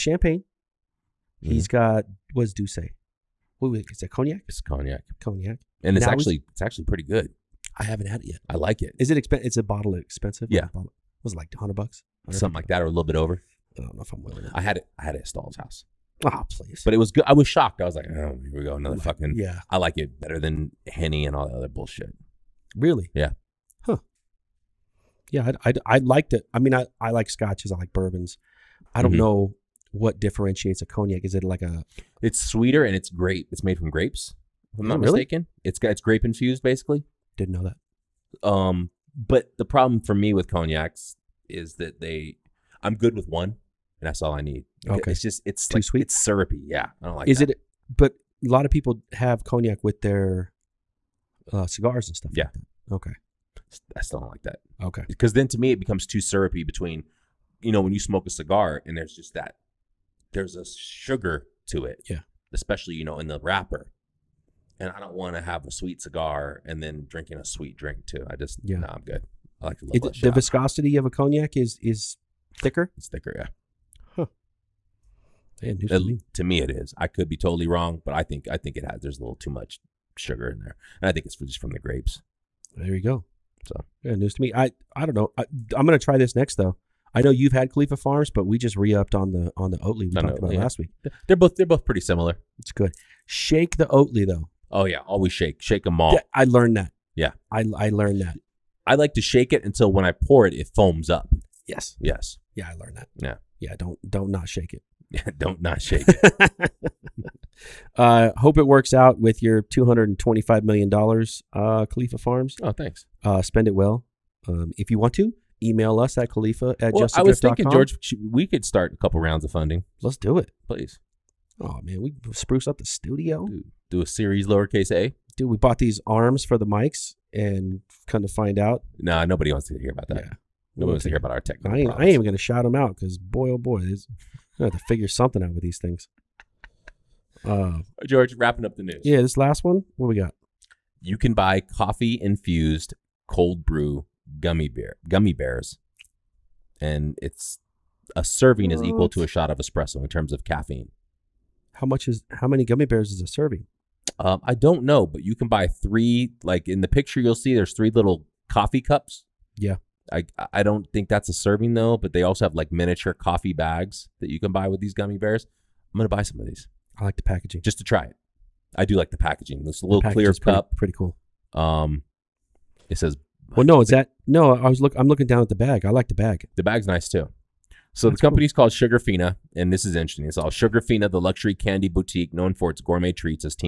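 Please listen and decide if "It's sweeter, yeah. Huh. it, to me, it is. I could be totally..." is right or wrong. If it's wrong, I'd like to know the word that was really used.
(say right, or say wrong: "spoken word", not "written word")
wrong: "thicker", not "sweeter".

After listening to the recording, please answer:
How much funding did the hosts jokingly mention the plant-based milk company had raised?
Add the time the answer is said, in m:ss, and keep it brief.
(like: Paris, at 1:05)
$225 million, at 1:49.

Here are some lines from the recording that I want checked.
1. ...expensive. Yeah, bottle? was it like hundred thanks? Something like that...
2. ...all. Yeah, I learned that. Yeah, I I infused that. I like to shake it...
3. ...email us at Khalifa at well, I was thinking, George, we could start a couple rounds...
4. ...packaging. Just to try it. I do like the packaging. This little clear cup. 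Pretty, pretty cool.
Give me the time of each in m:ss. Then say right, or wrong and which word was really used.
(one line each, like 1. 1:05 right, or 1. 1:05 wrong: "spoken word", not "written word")
1. 0:09 wrong: "bucks", not "thanks"
2. 1:35 wrong: "learned", not "infused"
3. 1:55 right
4. 2:47 right.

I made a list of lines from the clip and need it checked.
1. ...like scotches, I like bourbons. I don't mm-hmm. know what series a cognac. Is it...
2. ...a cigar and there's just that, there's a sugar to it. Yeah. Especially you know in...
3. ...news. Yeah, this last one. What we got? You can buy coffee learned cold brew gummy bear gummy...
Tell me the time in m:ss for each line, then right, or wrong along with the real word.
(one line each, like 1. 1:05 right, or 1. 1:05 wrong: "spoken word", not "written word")
1. 0:27 wrong: "differentiates", not "series"
2. 0:58 right
3. 2:18 wrong: "infused", not "learned".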